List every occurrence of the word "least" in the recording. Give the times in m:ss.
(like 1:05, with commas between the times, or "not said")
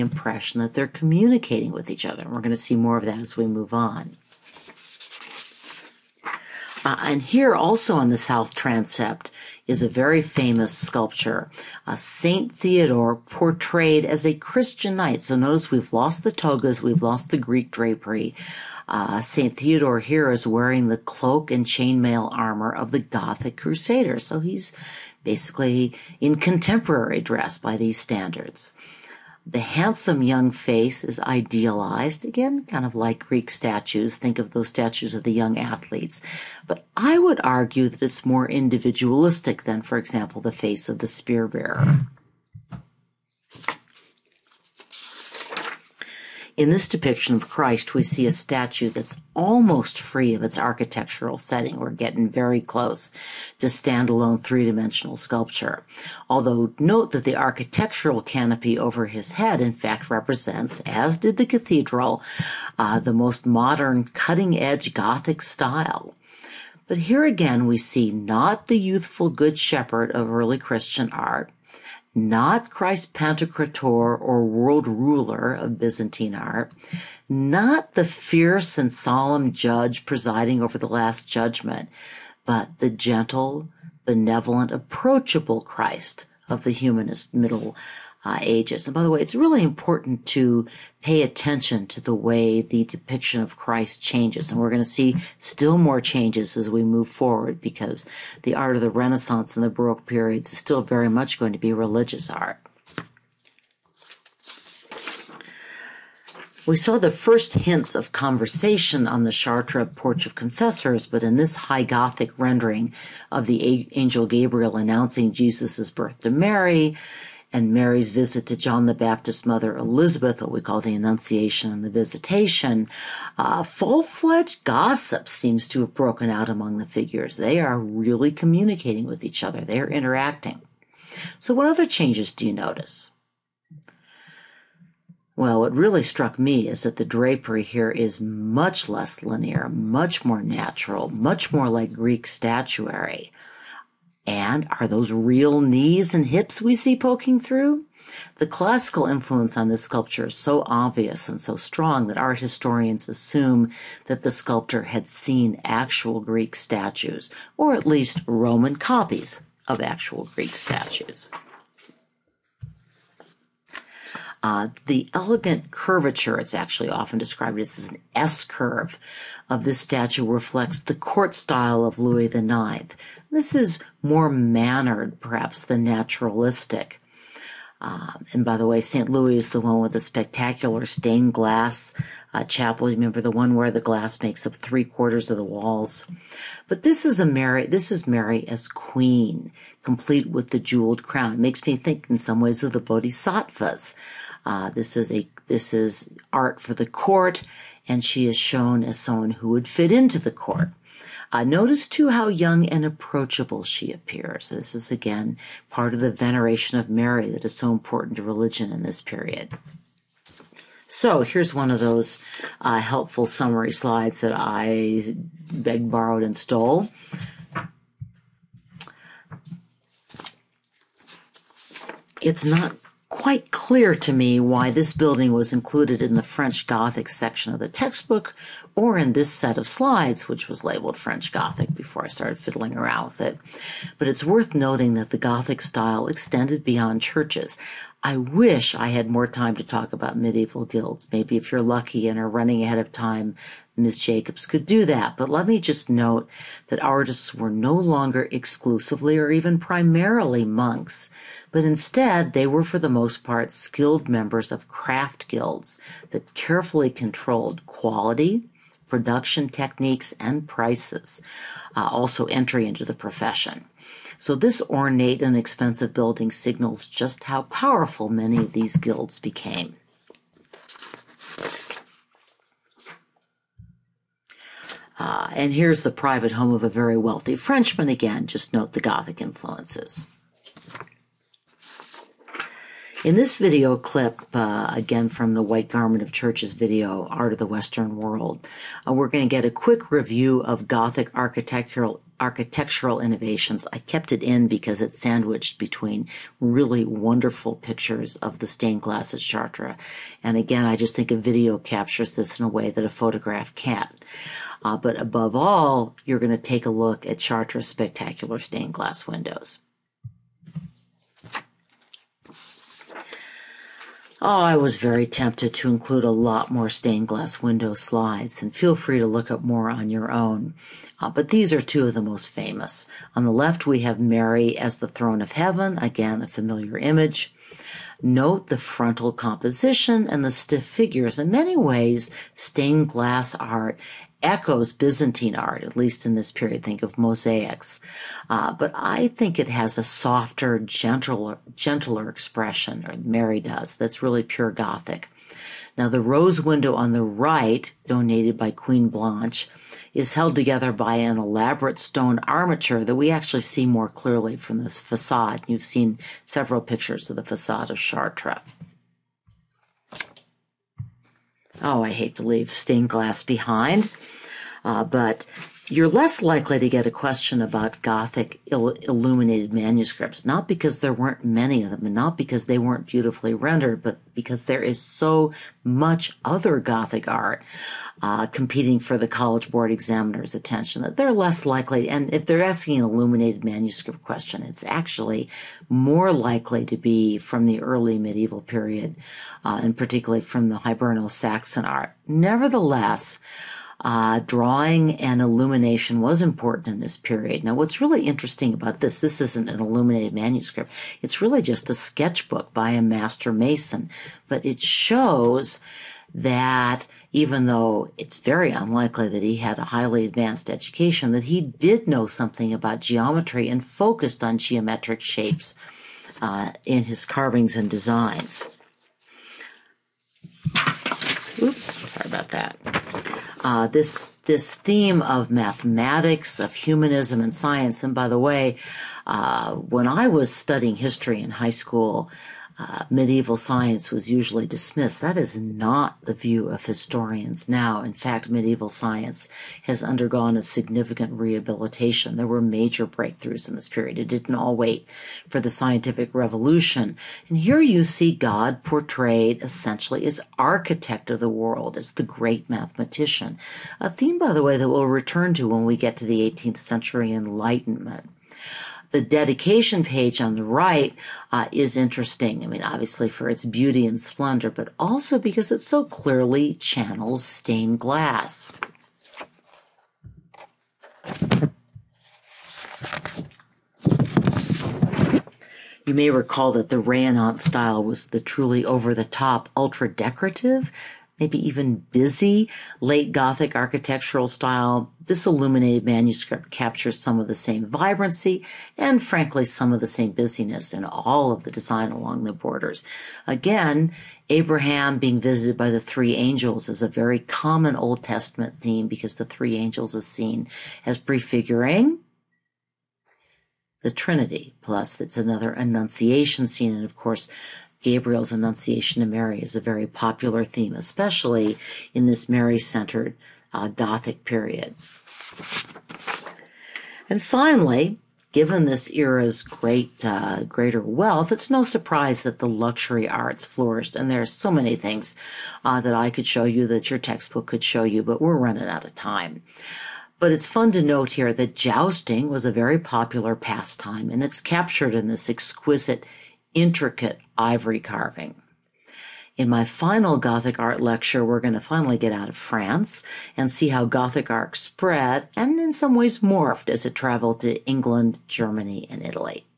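2:37, 5:35.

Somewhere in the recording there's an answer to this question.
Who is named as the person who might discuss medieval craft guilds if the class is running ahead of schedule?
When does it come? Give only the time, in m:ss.
4:03.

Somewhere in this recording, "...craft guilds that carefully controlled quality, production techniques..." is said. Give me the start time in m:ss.
4:14.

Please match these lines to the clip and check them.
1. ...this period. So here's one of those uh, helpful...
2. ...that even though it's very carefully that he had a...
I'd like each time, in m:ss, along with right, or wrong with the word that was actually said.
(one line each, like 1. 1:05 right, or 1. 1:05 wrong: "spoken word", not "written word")
1. 3:28 right
2. 6:46 wrong: "unlikely", not "carefully".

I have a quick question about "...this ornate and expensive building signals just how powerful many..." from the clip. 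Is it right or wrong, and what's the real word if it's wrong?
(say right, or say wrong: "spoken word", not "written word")
right.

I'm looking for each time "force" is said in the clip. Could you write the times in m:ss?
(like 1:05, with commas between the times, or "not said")
not said.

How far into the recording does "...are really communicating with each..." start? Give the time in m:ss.
2:07.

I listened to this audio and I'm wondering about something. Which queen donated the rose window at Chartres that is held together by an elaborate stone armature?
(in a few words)
Queen Blanche.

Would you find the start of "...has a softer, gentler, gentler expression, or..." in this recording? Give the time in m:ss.
5:39.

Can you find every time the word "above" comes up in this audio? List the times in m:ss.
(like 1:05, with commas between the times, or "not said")
5:04.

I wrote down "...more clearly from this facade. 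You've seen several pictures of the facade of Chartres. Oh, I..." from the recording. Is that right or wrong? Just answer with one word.
right.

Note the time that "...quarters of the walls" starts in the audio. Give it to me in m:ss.
3:04.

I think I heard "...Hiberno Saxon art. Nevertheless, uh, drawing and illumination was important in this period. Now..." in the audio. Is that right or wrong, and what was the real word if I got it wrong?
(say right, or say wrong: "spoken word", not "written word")
right.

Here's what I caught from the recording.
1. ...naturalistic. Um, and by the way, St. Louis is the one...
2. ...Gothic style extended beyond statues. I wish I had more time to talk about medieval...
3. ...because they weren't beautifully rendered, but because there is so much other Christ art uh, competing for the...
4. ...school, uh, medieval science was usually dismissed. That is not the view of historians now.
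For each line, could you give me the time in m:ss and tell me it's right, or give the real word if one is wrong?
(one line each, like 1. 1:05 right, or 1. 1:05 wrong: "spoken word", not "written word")
1. 2:55 right
2. 3:55 wrong: "churches", not "statues"
3. 6:12 wrong: "Gothic", not "Christ"
4. 7:11 right.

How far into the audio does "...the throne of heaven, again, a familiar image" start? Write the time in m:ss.
5:24.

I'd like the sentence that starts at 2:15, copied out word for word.
Well, what really struck me is that the drapery here is much less linear, much more natural, much more like Greek statuary.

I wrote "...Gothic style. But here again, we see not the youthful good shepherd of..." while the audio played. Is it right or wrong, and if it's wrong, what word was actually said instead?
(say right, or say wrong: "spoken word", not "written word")
right.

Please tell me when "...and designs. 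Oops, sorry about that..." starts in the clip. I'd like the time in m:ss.
6:57.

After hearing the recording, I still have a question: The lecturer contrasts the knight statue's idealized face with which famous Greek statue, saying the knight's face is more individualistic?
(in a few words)
The spear bearer.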